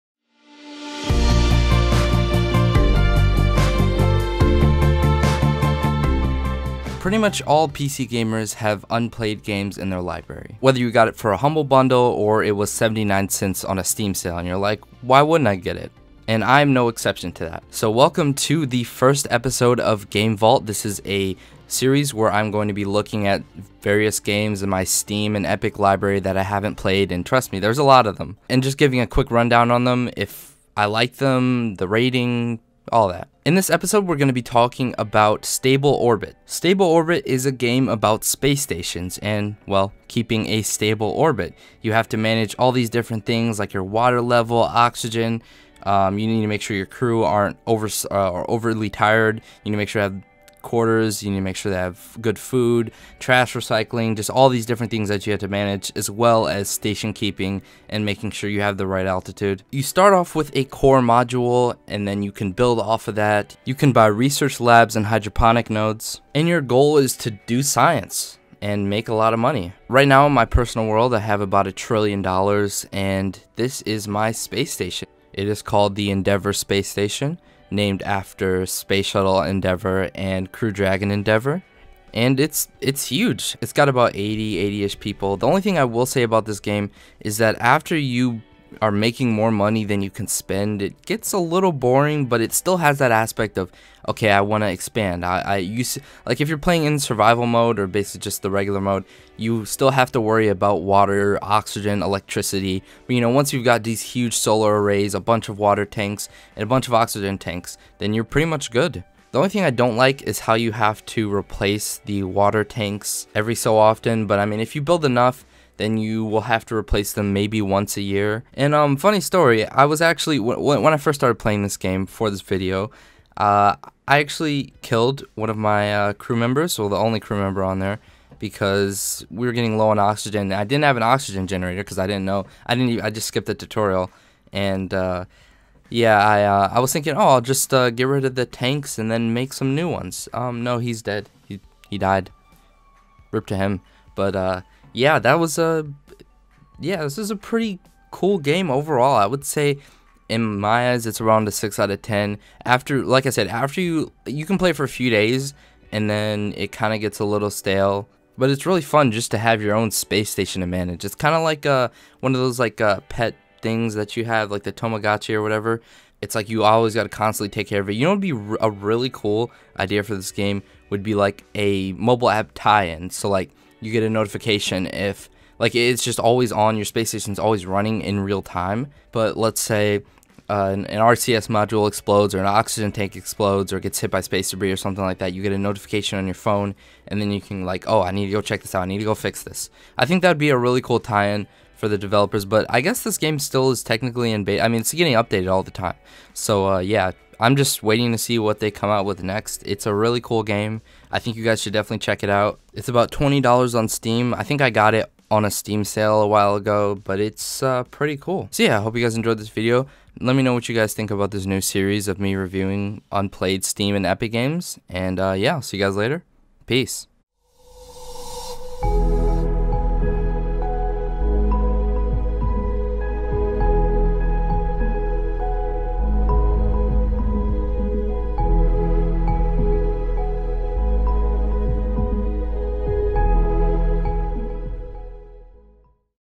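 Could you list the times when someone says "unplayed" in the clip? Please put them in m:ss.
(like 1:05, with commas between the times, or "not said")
0:08, 3:33.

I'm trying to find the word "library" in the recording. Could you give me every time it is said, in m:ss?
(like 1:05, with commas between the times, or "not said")
0:10, 0:25.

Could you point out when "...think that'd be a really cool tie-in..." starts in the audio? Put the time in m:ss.
3:10.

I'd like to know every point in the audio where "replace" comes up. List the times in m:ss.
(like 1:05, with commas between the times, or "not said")
1:51, 1:56.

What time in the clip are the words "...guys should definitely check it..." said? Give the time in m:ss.
3:21.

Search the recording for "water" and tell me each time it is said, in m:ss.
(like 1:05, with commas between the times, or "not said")
0:43, 1:40, 1:45, 1:52.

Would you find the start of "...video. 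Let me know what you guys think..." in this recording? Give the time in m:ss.
3:29.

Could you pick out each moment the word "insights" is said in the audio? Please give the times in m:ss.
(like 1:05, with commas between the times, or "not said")
not said.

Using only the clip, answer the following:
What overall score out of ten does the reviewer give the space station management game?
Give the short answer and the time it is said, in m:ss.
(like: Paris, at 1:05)
6 out of 10, at 2:31.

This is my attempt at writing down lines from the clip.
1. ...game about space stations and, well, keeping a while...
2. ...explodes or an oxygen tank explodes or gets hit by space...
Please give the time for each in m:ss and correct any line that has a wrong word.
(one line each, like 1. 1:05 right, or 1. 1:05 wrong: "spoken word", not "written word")
1. 0:37 wrong: "stable", not "while"
2. 3:01 right.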